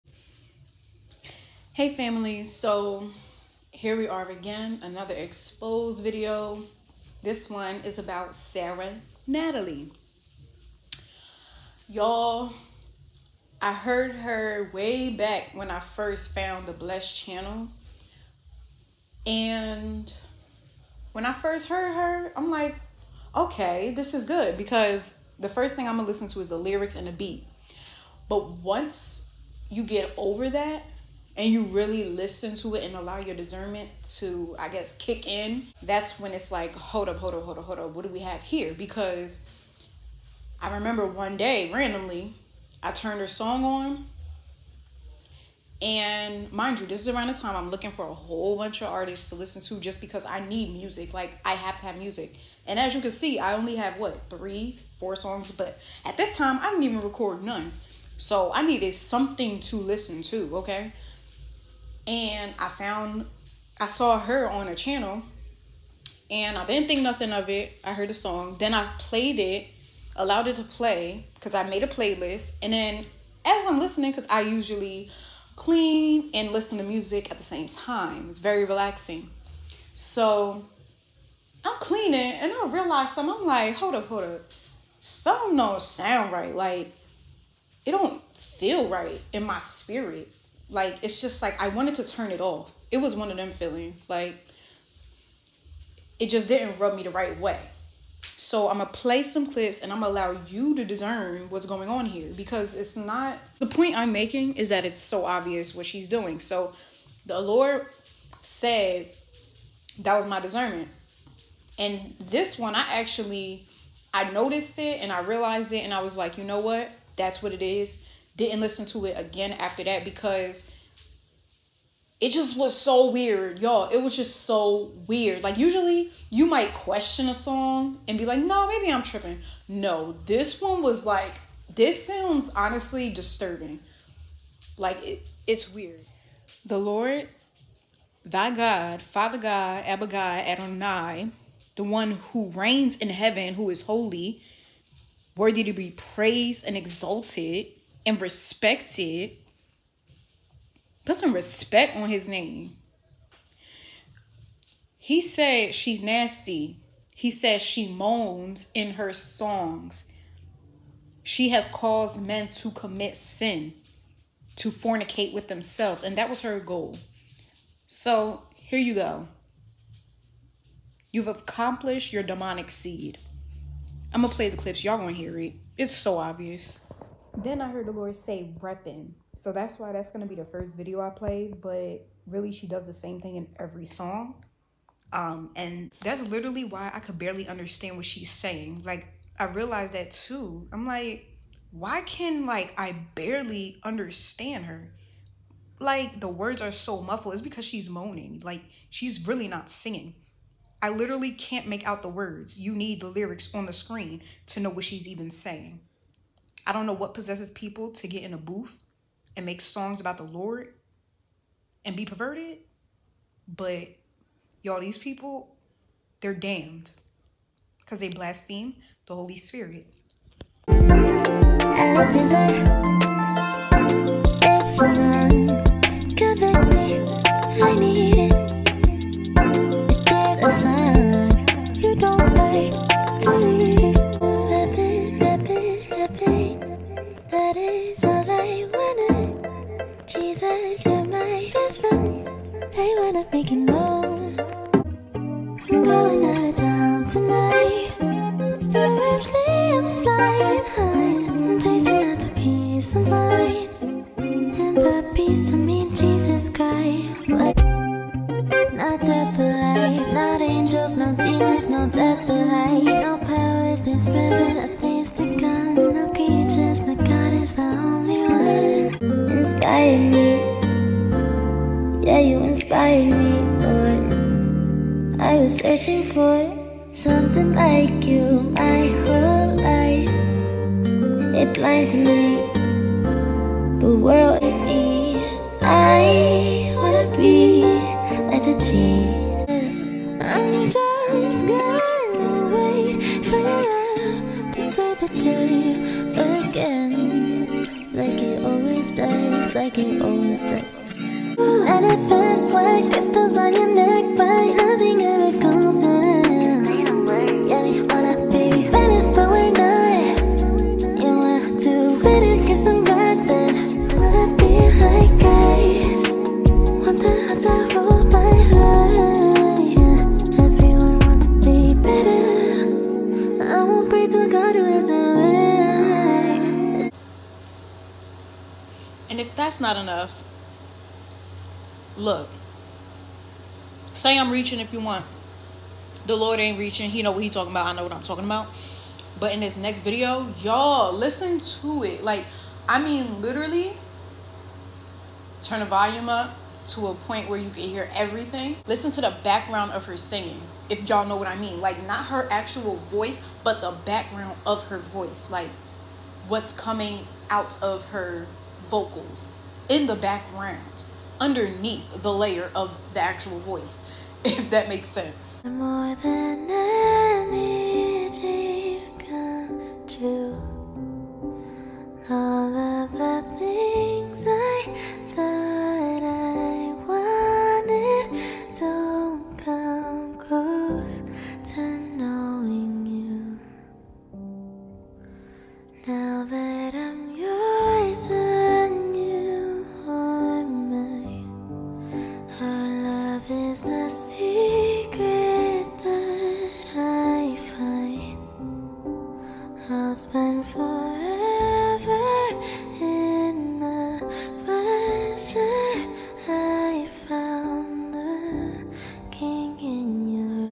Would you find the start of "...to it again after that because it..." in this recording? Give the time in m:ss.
1:58.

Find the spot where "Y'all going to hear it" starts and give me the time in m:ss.
2:54.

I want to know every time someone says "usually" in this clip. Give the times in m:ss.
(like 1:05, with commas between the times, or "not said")
1:14, 2:05.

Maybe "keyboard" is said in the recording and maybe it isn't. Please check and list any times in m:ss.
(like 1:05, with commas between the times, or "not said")
not said.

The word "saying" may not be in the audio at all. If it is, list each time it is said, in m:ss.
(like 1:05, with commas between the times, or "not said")
3:08, 3:25.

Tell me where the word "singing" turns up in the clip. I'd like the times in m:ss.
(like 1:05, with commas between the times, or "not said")
3:19, 5:49.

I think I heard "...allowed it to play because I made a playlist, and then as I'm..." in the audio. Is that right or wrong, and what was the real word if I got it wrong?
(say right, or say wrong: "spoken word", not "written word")
right.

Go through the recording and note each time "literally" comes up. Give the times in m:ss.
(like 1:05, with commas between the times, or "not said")
3:06, 3:20, 5:43.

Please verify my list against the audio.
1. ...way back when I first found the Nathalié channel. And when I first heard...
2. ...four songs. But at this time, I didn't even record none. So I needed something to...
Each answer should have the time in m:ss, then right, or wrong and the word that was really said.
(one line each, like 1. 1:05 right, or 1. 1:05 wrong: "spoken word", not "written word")
1. 0:14 wrong: "Blessed", not "Nathalié"
2. 0:54 right.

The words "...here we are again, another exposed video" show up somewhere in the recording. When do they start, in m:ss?
0:03.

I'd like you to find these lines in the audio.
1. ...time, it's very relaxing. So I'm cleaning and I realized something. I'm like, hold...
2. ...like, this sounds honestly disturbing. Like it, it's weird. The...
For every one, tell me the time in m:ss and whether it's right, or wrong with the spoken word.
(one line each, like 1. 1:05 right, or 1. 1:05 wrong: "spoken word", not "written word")
1. 1:17 right
2. 2:11 right.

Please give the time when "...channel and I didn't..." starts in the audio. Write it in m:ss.
1:04.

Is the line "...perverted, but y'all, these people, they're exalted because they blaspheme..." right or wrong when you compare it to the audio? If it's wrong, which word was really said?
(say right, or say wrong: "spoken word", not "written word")
wrong: "damned", not "exalted".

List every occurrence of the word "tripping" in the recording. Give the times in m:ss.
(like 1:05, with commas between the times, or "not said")
2:09.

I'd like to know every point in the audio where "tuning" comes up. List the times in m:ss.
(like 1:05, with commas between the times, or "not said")
not said.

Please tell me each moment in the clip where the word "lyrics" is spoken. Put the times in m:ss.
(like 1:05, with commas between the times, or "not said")
0:26, 3:23.